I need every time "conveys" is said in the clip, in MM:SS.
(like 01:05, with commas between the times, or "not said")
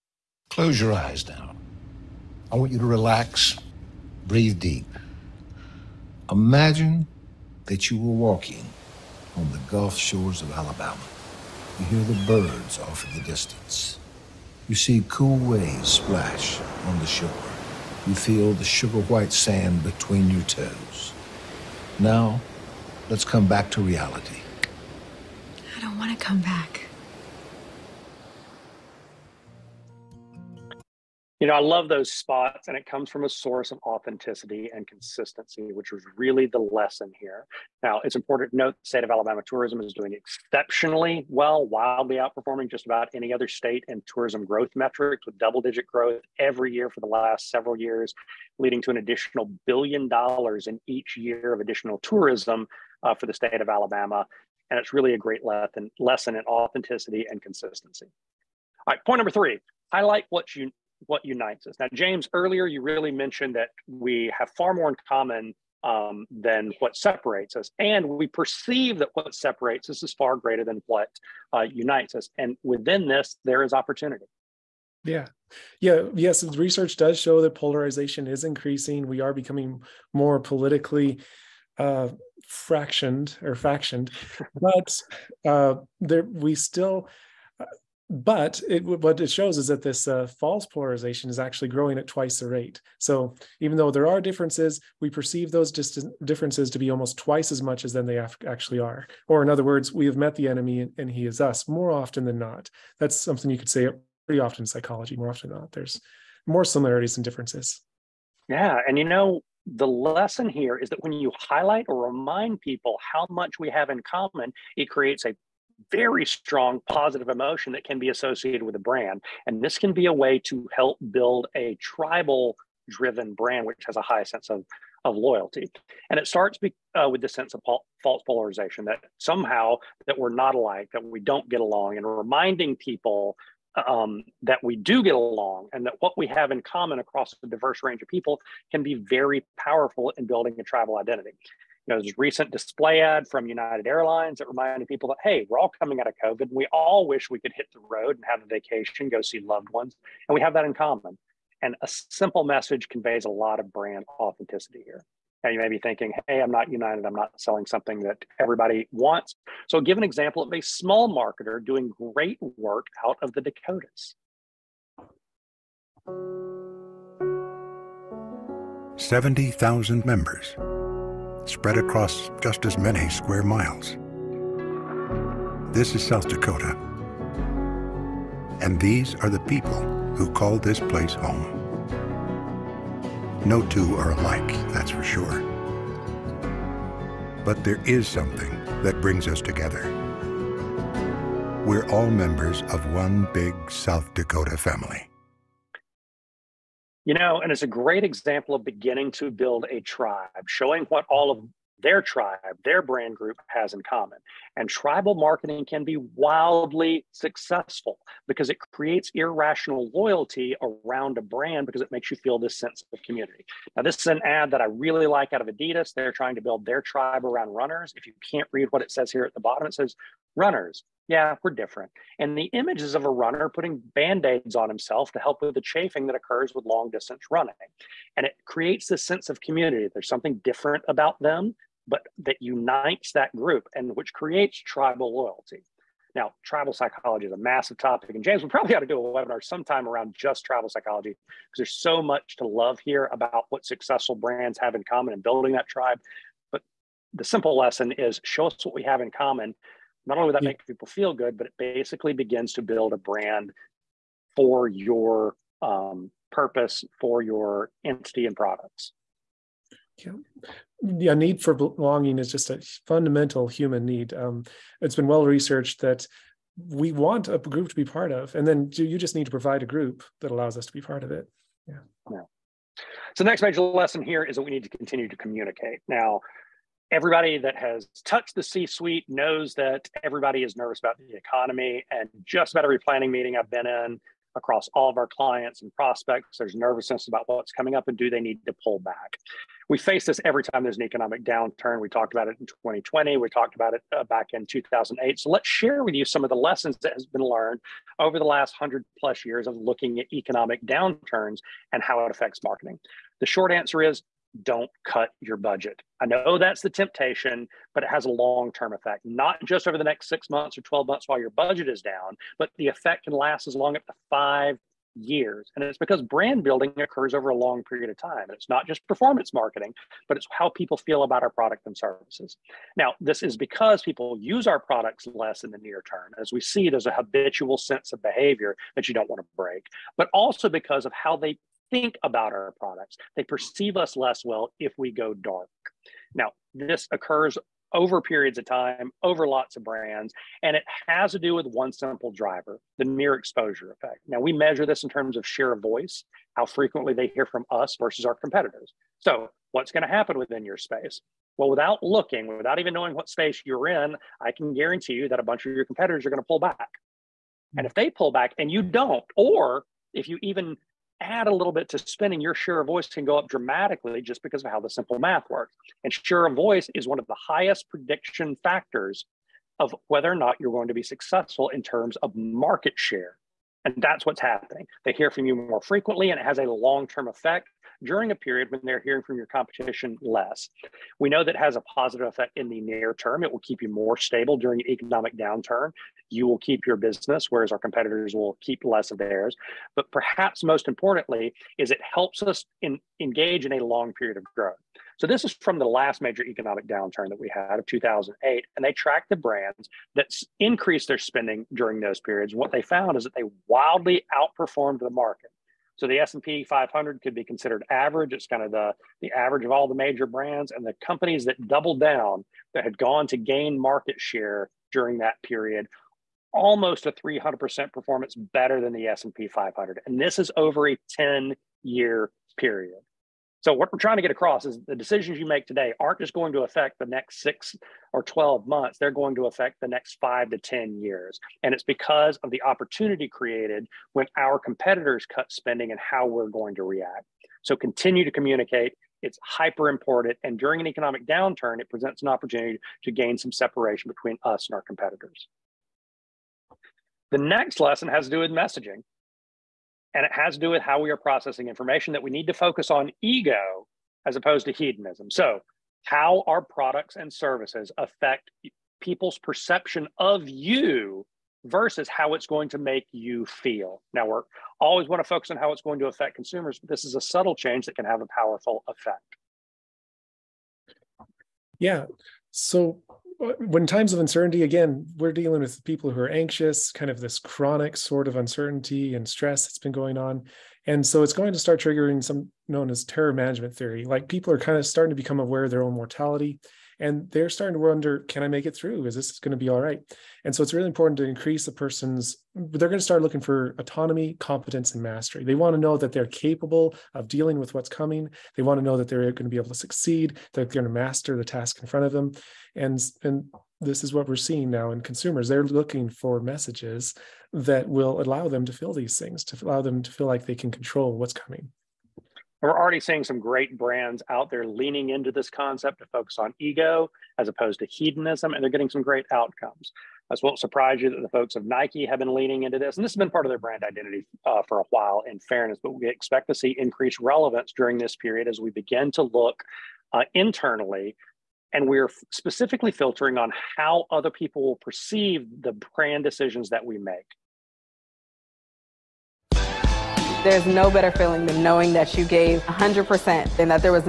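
02:32.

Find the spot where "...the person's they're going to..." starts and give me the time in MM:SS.
08:11.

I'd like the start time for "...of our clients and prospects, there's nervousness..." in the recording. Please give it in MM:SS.
04:44.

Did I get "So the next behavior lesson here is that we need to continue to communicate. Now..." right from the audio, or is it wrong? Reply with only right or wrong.
wrong.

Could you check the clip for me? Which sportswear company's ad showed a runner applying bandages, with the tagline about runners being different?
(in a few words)
Adidas.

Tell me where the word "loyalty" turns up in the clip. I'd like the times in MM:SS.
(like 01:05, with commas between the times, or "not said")
02:05, 03:29, 03:55.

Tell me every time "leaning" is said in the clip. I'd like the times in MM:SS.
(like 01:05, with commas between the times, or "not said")
08:34, 08:42.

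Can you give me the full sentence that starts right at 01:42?
That's something you could say pretty often in psychology.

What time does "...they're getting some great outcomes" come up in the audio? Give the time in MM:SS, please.
08:38.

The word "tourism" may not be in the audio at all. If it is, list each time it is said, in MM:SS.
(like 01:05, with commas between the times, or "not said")
00:39, 00:44, 00:51.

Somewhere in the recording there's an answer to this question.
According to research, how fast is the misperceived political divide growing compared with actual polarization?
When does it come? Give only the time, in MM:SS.
01:32.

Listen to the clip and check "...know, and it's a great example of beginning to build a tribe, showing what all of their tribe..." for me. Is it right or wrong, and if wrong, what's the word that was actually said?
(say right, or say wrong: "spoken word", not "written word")
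right.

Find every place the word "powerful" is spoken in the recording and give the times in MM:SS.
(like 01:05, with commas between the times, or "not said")
02:19, 07:48.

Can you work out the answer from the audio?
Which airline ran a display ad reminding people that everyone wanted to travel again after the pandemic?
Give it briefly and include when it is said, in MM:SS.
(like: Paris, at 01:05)
United Airlines, at 02:23.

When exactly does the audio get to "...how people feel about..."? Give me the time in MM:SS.
05:20.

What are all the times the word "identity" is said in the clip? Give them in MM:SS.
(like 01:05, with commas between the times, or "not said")
02:20, 08:43.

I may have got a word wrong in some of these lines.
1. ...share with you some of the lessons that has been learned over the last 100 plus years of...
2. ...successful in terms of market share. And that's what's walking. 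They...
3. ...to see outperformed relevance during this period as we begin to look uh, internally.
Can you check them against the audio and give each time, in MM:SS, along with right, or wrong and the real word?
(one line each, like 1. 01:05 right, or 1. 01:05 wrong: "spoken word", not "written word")
1. 04:55 right
2. 06:10 wrong: "happening", not "walking"
3. 08:46 wrong: "increased", not "outperformed".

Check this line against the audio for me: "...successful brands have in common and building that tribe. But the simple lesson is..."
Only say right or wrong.
right.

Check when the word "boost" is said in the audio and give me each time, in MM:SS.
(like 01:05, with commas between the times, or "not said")
not said.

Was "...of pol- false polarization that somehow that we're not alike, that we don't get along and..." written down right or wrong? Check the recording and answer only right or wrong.
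right.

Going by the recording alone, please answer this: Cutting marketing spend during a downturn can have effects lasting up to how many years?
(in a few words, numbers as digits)
5 years.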